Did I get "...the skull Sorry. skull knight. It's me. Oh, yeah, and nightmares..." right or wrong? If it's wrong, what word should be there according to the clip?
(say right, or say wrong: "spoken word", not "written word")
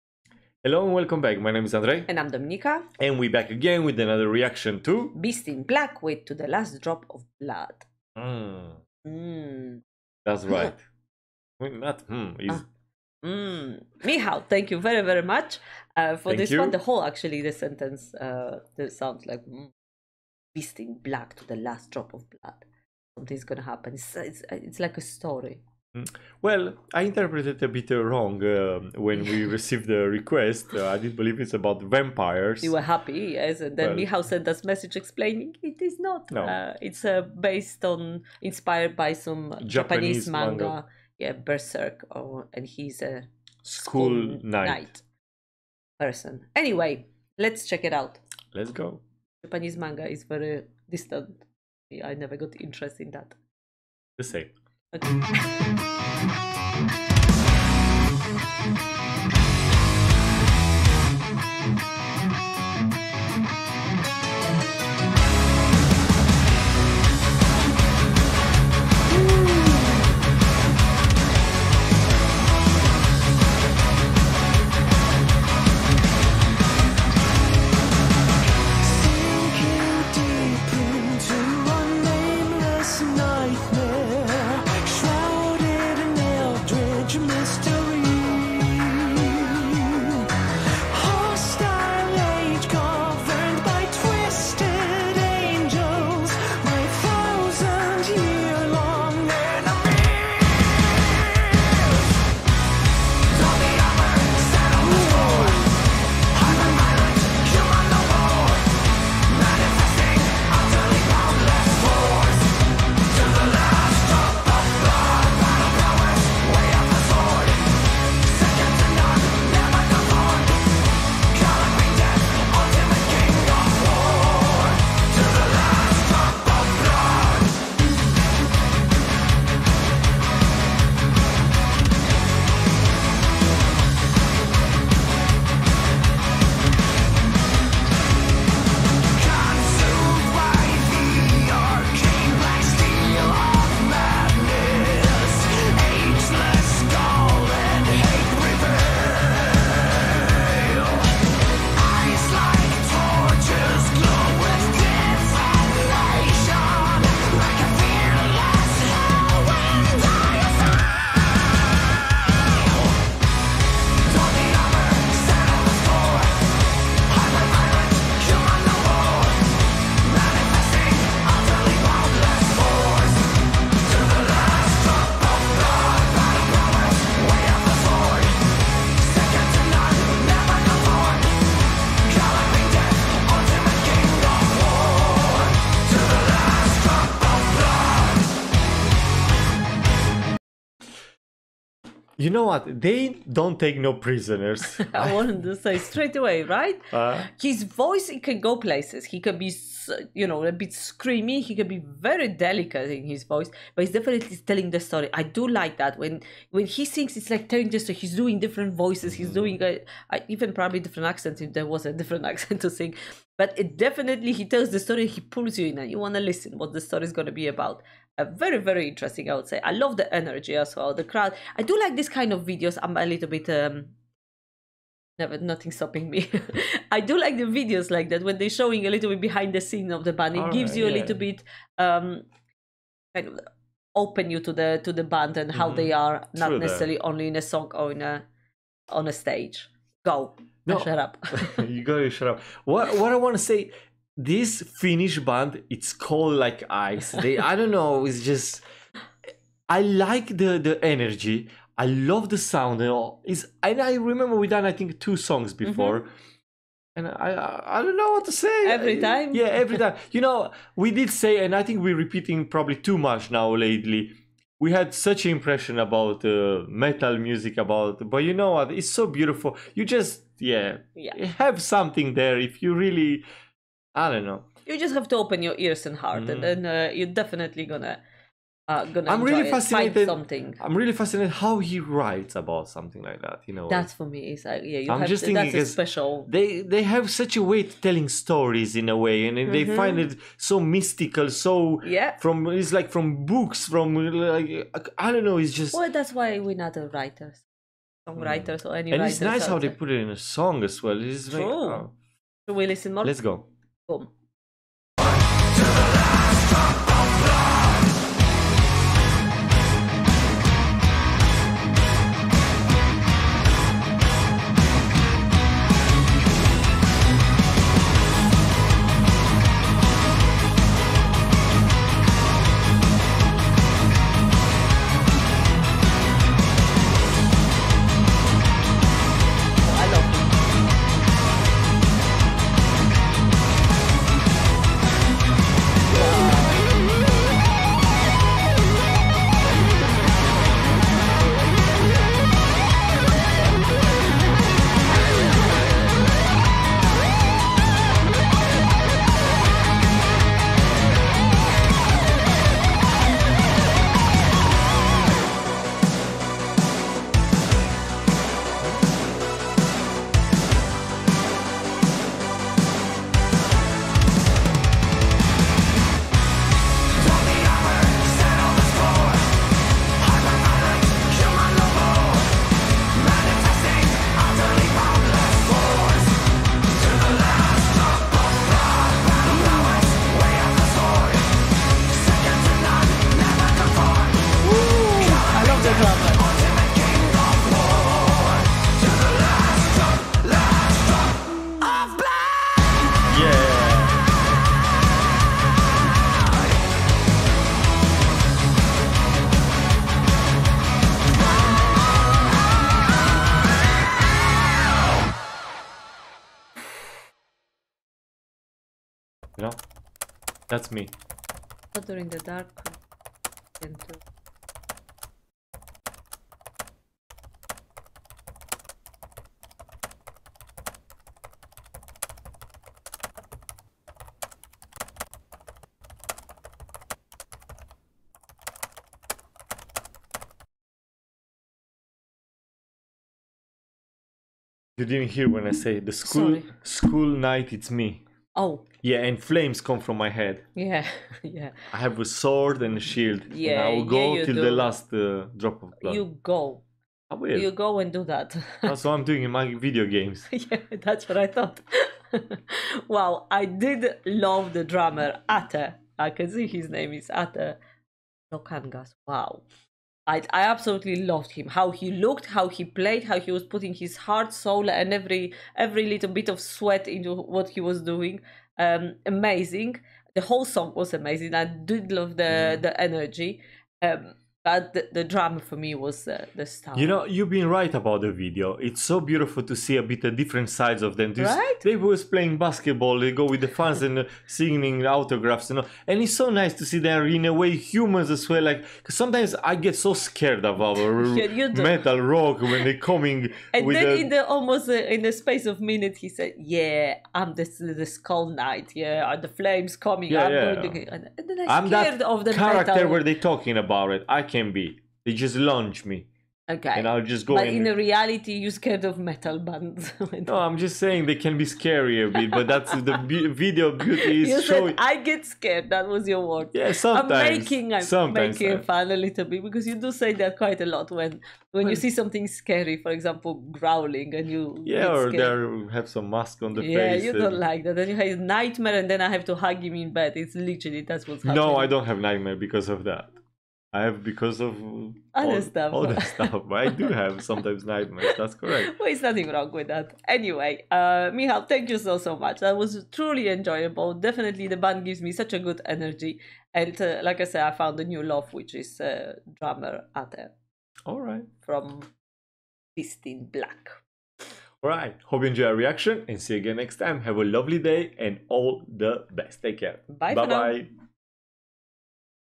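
wrong: "flames", not "nightmares".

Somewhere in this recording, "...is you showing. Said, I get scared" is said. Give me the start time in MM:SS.
08:34.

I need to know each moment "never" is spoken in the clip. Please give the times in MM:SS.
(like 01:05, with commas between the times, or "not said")
00:52, 03:45.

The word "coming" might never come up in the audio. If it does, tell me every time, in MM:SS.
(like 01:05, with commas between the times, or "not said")
08:12, 08:19.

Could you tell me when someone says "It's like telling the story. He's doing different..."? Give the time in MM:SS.
03:27.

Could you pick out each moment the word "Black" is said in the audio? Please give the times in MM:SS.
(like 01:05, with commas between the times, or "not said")
00:05, 00:20, 09:13.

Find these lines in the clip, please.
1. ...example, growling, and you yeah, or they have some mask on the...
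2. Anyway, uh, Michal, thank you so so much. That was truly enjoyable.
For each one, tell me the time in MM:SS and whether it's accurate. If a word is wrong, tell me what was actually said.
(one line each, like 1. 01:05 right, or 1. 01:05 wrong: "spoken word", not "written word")
1. 08:42 right
2. 09:00 right.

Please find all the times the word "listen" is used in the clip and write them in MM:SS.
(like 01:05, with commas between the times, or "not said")
03:36, 05:02.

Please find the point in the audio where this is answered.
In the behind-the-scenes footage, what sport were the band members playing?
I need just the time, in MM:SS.
08:02.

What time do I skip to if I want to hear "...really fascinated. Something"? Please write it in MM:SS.
04:39.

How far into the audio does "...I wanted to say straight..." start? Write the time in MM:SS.
03:14.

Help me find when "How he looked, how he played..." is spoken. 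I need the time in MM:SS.
07:41.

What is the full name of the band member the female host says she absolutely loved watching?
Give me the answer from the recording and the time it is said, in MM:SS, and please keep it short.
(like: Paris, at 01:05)
Atte Palokangas, at 07:37.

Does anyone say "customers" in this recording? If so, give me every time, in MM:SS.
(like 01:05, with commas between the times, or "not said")
not said.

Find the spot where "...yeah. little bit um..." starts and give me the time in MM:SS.
03:50.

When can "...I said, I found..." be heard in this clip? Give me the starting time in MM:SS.
09:07.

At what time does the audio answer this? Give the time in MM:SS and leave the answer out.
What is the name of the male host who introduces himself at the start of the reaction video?
00:01.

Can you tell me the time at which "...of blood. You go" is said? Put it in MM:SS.
07:25.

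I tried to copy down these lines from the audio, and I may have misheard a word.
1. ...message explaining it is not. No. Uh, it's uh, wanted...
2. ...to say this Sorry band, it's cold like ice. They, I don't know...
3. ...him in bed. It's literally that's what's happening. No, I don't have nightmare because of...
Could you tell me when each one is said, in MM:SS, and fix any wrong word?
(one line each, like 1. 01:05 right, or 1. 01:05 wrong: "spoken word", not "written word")
1. 00:34 wrong: "based", not "wanted"
2. 04:03 wrong: "Finnish", not "Sorry"
3. 08:49 right.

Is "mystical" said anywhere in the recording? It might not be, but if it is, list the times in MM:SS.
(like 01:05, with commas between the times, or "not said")
04:50.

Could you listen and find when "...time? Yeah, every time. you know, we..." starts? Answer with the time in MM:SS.
04:18.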